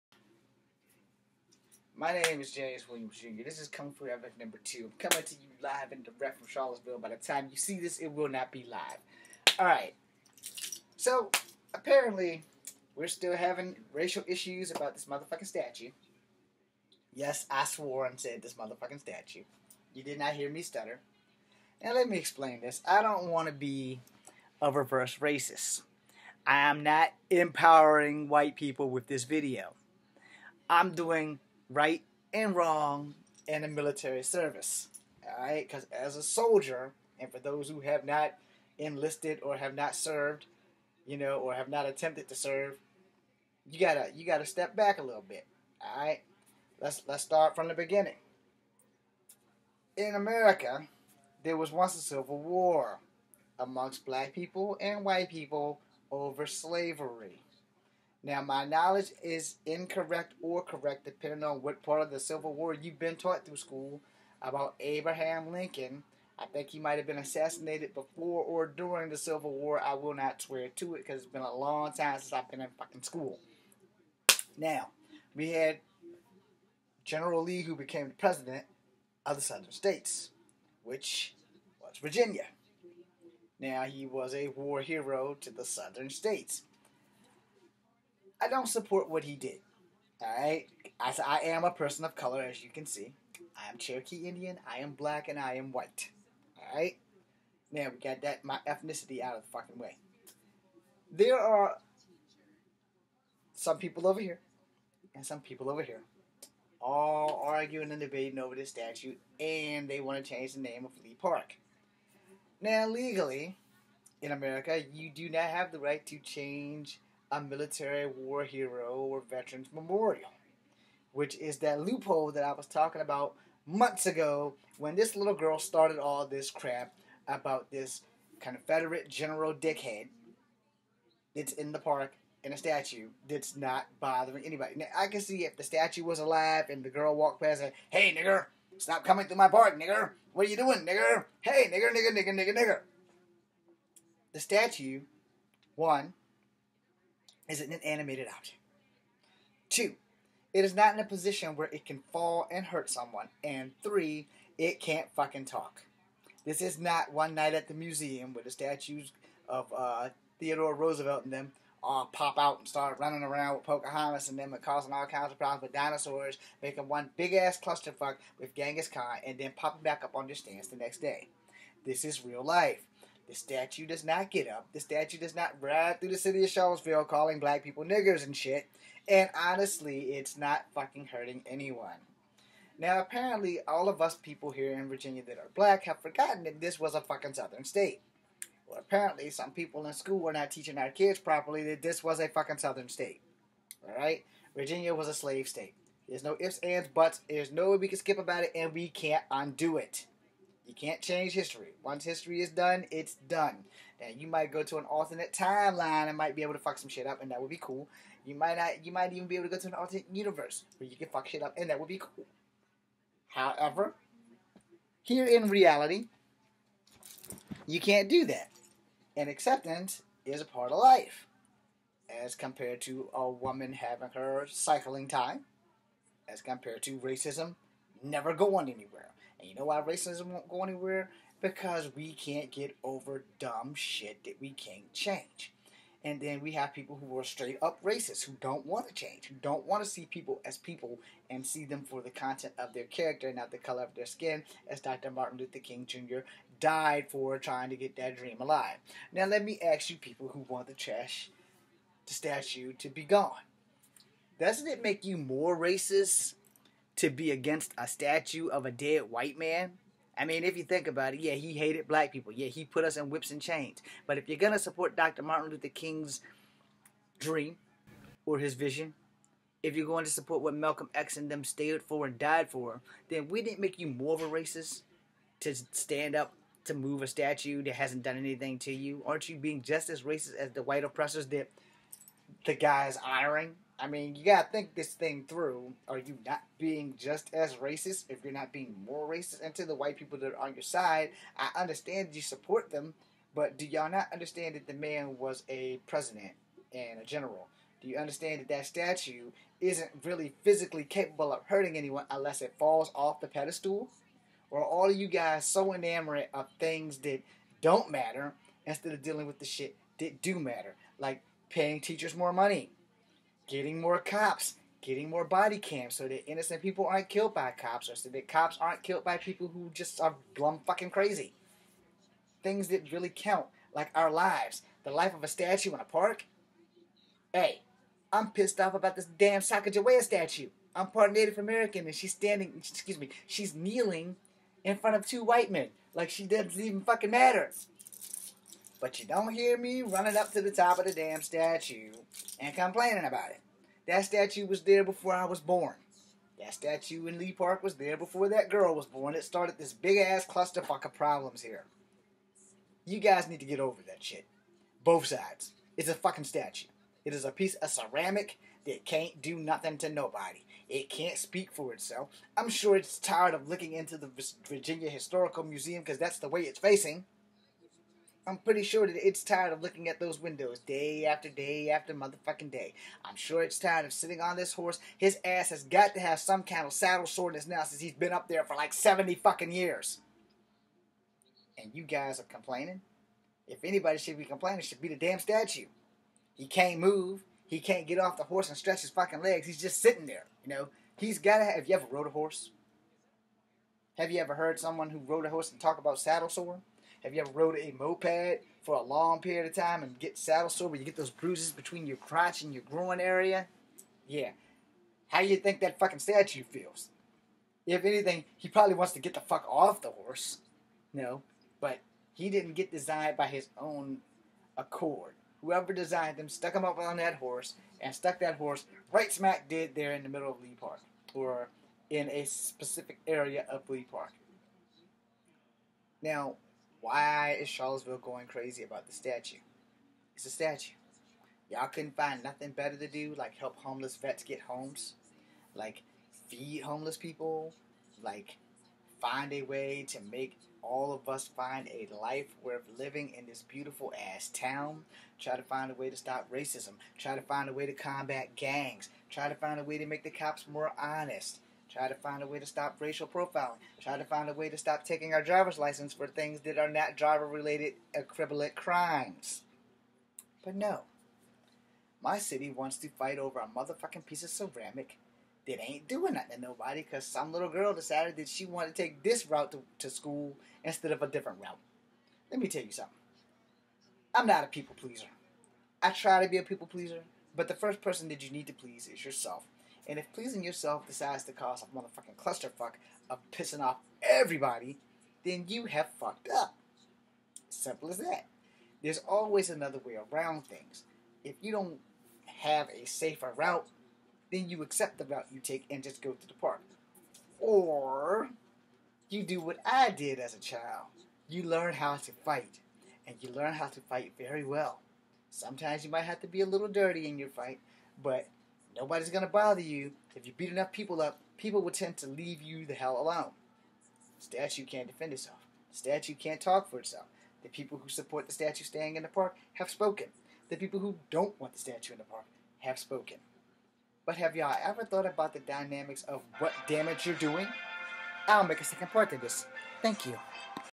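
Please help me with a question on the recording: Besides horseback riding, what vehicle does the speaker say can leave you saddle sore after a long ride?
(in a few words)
moped.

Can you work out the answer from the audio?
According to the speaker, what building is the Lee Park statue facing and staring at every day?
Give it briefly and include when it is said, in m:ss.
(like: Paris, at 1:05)
Virginia Historical Museum, at 6:04.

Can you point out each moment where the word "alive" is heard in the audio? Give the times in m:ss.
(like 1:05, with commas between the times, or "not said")
2:16, 4:08.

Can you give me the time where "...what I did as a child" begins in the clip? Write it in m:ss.
8:19.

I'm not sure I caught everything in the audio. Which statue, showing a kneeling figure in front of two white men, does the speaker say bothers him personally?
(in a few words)
Sacagawea.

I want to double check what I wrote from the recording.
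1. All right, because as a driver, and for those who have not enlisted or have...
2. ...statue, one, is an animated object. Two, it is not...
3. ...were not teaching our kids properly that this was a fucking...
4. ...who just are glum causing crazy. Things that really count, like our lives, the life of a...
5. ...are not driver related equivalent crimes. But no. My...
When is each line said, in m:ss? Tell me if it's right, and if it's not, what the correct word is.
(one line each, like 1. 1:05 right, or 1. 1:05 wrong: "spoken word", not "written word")
1. 0:35 wrong: "soldier", not "driver"
2. 2:24 right
3. 3:10 right
4. 5:19 wrong: "fucking", not "causing"
5. 7:36 right.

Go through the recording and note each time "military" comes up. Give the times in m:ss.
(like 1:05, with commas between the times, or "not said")
0:33, 1:57.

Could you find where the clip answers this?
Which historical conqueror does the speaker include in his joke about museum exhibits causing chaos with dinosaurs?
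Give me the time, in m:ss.
2:48.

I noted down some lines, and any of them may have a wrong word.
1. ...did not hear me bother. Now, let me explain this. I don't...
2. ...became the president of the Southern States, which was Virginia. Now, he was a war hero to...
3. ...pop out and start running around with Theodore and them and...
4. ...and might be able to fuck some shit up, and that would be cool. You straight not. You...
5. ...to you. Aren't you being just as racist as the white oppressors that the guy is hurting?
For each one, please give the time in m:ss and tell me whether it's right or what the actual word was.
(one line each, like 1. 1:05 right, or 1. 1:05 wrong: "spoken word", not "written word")
1. 0:20 wrong: "stutter", not "bother"
2. 1:17 right
3. 2:42 wrong: "Pocahontas", not "Theodore"
4. 3:26 wrong: "might", not "straight"
5. 4:38 wrong: "honoring", not "hurting".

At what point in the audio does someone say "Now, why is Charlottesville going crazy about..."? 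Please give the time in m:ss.
7:06.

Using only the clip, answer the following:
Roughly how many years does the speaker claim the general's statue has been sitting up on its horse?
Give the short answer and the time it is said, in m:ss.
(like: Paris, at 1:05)
70, at 6:18.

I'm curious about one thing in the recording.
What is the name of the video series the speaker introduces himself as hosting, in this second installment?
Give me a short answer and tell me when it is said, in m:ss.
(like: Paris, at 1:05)
Kung Fu Havok, at 0:03.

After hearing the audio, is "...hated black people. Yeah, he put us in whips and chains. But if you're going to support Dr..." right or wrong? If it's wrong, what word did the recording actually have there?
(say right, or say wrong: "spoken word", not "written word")
right.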